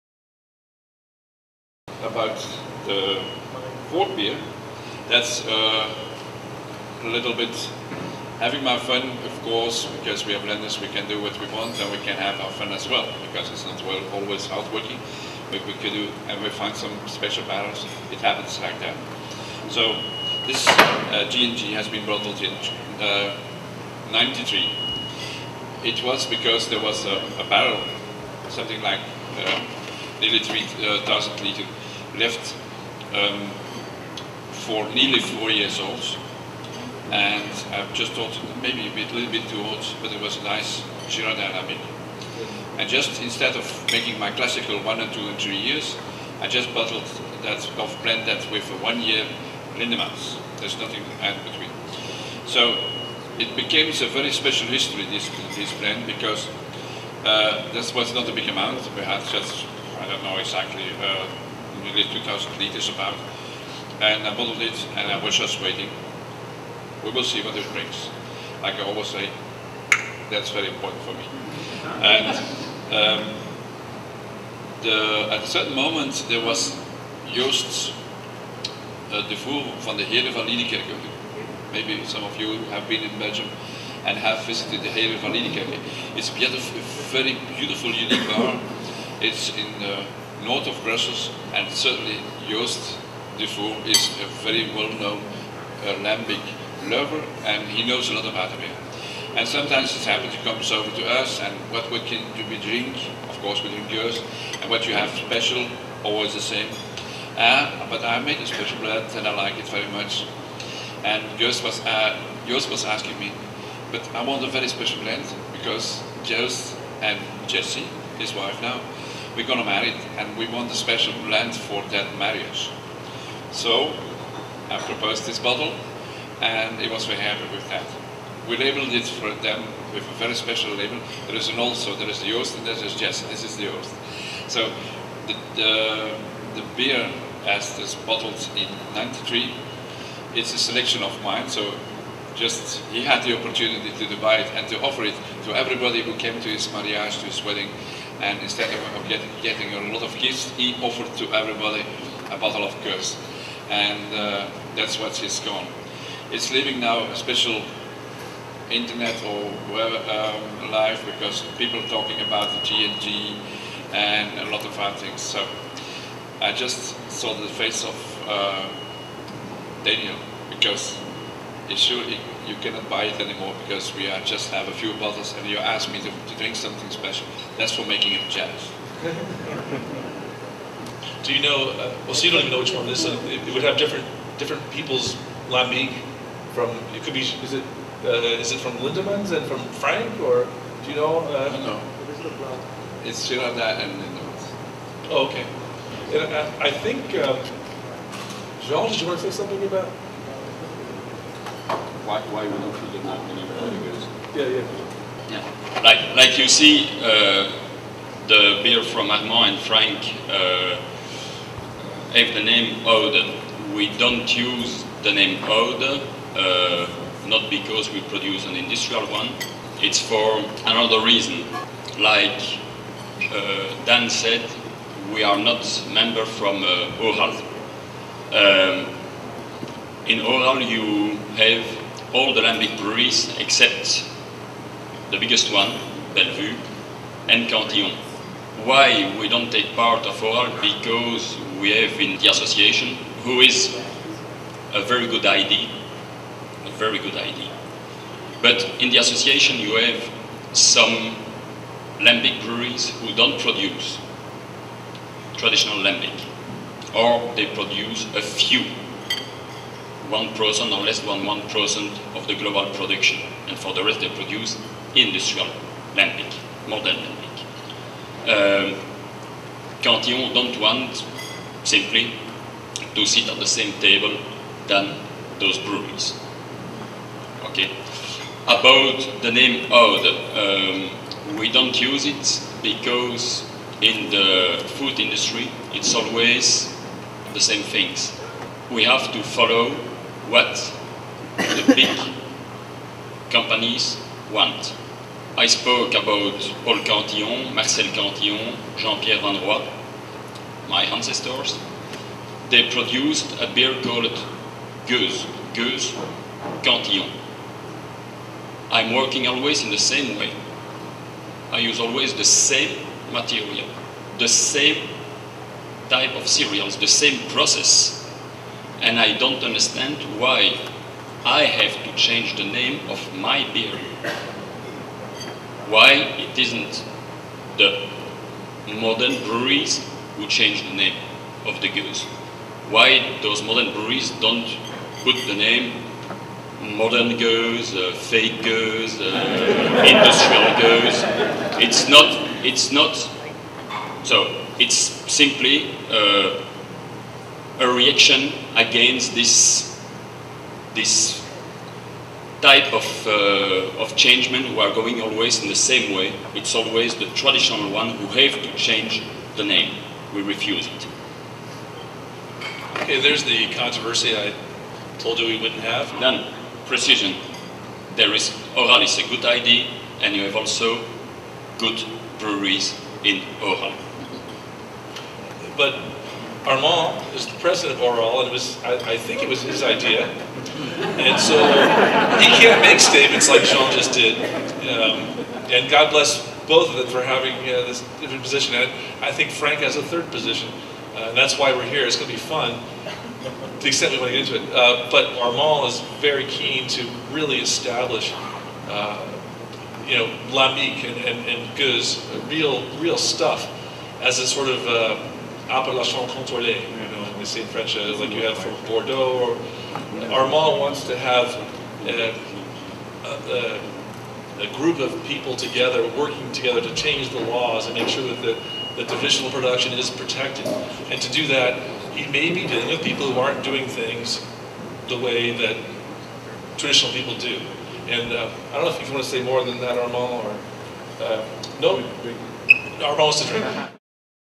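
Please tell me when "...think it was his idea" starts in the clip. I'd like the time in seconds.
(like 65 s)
378 s.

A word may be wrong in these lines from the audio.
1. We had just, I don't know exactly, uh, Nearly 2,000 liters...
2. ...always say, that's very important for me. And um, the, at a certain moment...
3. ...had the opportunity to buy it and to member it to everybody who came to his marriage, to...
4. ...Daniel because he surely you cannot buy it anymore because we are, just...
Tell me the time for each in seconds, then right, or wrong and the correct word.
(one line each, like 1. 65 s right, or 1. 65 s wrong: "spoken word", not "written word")
1. 58 s right
2. 68 s right
3. 143 s wrong: "offer", not "member"
4. 169 s right.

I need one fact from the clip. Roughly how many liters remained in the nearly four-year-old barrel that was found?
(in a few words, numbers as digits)
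3,000 liters.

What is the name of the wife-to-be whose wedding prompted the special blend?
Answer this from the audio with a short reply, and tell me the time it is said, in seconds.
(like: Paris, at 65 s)
Jessie, at 117 s.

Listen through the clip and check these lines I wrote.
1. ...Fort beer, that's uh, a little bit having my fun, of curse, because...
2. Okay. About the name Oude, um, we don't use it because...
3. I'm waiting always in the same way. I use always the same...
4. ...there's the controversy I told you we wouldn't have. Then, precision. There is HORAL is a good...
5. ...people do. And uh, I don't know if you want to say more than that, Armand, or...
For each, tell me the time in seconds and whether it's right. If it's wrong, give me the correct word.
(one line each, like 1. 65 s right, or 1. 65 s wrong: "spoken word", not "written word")
1. 3 s wrong: "course", not "curse"
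2. 277 s right
3. 308 s wrong: "working", not "waiting"
4. 362 s right
5. 426 s right.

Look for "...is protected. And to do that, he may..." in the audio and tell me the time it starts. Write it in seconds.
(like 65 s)
419 s.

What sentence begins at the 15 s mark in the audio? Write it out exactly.
We, could do, and we find some special barrels.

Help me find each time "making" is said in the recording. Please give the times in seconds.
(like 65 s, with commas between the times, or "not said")
43 s, 177 s.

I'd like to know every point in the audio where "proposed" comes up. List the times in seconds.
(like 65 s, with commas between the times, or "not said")
124 s.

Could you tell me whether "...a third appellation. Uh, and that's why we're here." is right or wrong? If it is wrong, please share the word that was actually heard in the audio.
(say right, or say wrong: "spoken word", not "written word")
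wrong: "position", not "appellation".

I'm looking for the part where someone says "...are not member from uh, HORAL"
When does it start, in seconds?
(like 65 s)
225 s.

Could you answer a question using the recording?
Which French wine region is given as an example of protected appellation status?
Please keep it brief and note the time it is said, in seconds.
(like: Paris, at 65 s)
Bordeaux, at 408 s.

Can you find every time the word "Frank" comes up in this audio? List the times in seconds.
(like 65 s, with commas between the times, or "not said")
189 s, 209 s, 389 s.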